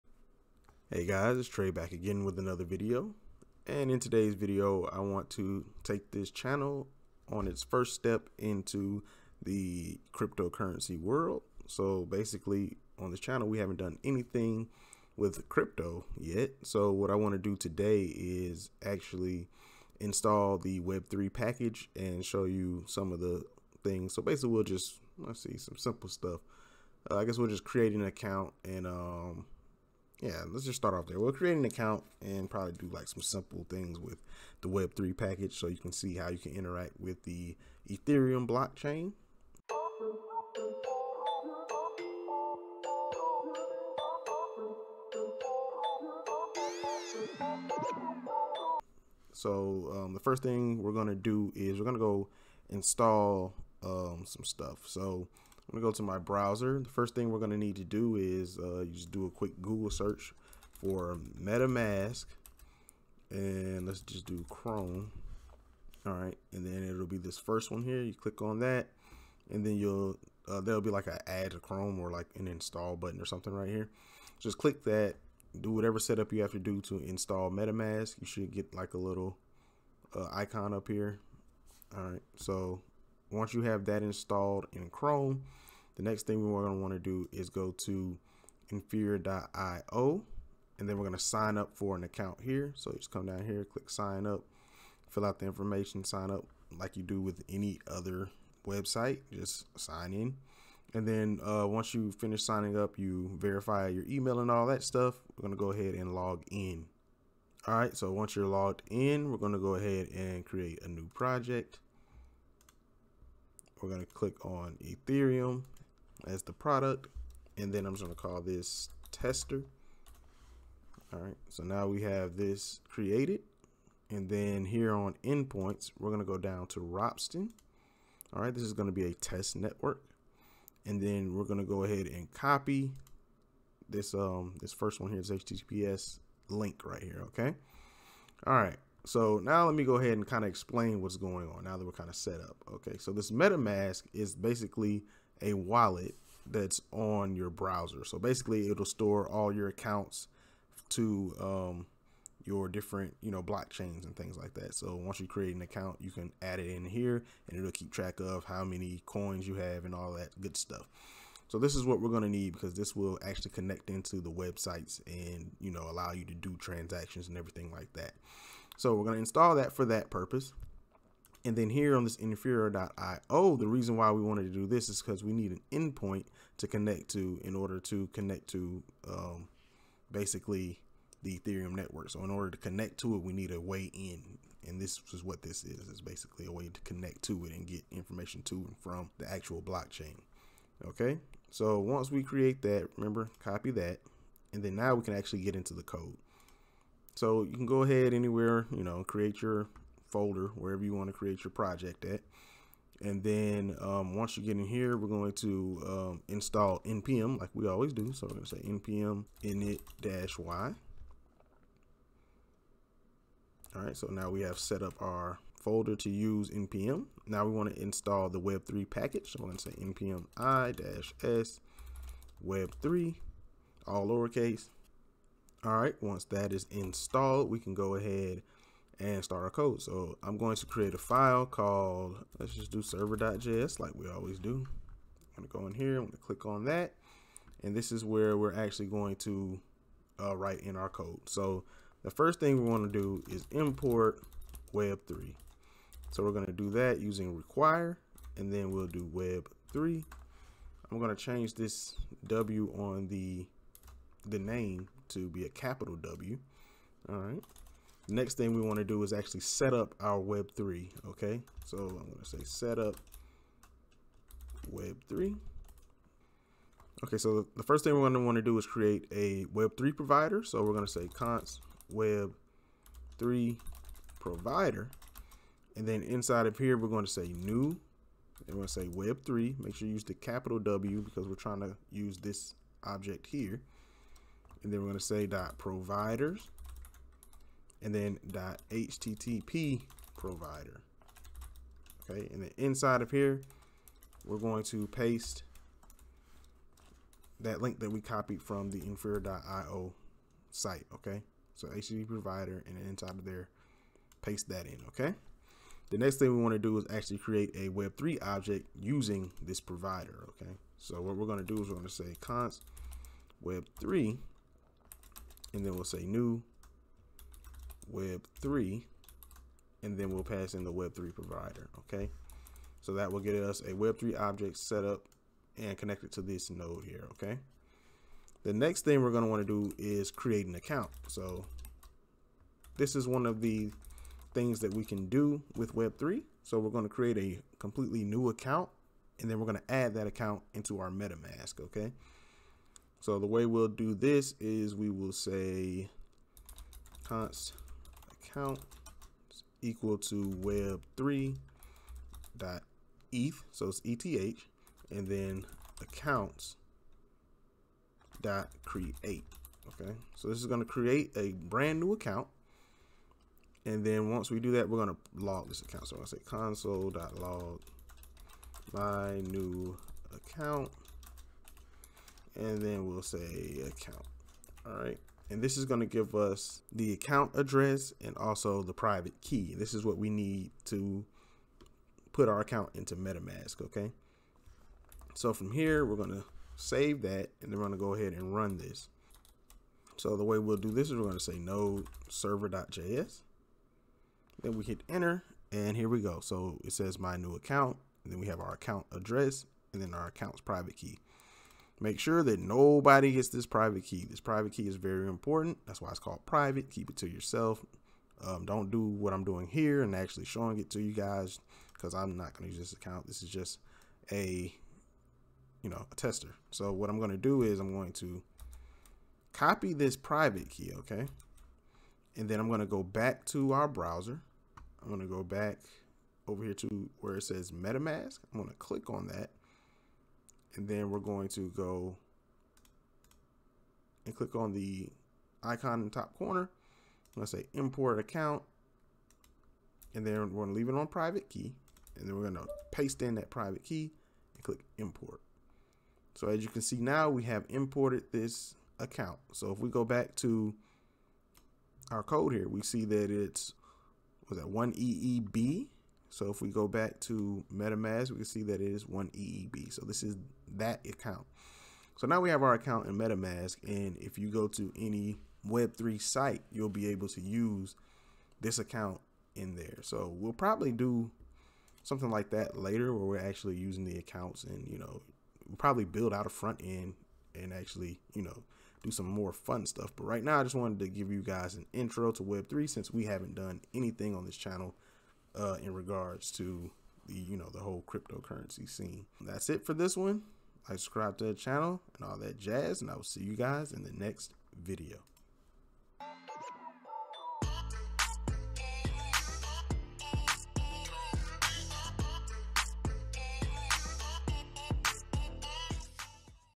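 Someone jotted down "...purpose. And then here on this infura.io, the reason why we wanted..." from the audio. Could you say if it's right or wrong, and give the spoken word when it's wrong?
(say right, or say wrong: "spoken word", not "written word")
right.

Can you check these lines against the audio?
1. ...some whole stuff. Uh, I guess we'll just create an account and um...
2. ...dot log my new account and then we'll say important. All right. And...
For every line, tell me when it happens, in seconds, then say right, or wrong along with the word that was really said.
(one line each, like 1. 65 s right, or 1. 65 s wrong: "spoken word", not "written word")
1. 25 s wrong: "simple", not "whole"
2. 366 s wrong: "account", not "important".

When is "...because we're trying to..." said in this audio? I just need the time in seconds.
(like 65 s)
281 s.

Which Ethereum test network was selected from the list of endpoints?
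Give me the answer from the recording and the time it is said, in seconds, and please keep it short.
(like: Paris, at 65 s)
Ropsten, at 126 s.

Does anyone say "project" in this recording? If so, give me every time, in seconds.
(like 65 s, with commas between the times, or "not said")
111 s, 201 s.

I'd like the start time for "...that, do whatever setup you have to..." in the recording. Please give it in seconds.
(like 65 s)
74 s.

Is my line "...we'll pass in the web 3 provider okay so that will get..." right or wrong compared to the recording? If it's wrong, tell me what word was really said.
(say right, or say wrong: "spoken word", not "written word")
right.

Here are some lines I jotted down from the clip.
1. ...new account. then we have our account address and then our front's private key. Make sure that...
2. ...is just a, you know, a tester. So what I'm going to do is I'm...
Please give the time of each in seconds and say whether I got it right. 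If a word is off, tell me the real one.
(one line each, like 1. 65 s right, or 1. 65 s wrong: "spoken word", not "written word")
1. 397 s wrong: "account", not "front"
2. 413 s right.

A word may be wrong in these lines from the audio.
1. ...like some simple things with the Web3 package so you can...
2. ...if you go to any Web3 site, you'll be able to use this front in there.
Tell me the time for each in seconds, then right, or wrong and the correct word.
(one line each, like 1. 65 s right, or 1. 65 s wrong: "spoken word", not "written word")
1. 32 s right
2. 463 s wrong: "account", not "front".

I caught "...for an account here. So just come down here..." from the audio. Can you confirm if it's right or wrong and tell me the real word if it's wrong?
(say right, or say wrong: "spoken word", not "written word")
right.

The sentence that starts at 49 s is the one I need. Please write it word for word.
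So um, the first thing we're going to do is we're going to go install um, some stuff.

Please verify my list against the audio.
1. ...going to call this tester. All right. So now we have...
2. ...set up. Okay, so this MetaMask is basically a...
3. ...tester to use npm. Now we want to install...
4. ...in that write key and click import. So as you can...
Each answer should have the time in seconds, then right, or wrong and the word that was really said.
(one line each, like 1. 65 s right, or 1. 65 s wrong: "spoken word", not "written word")
1. 118 s right
2. 142 s right
3. 215 s wrong: "folder", not "tester"
4. 443 s wrong: "private", not "write".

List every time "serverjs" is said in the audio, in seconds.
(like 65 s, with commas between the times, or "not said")
232 s, 392 s.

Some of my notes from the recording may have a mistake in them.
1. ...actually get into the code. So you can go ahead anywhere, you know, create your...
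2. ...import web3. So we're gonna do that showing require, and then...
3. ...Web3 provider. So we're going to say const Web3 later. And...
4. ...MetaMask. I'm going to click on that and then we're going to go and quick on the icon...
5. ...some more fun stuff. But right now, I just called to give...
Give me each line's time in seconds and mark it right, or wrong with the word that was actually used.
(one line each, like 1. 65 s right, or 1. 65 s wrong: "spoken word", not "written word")
1. 195 s right
2. 243 s wrong: "using", not "showing"
3. 269 s wrong: "provider", not "later"
4. 427 s wrong: "click", not "quick"
5. 478 s wrong: "wanted", not "called".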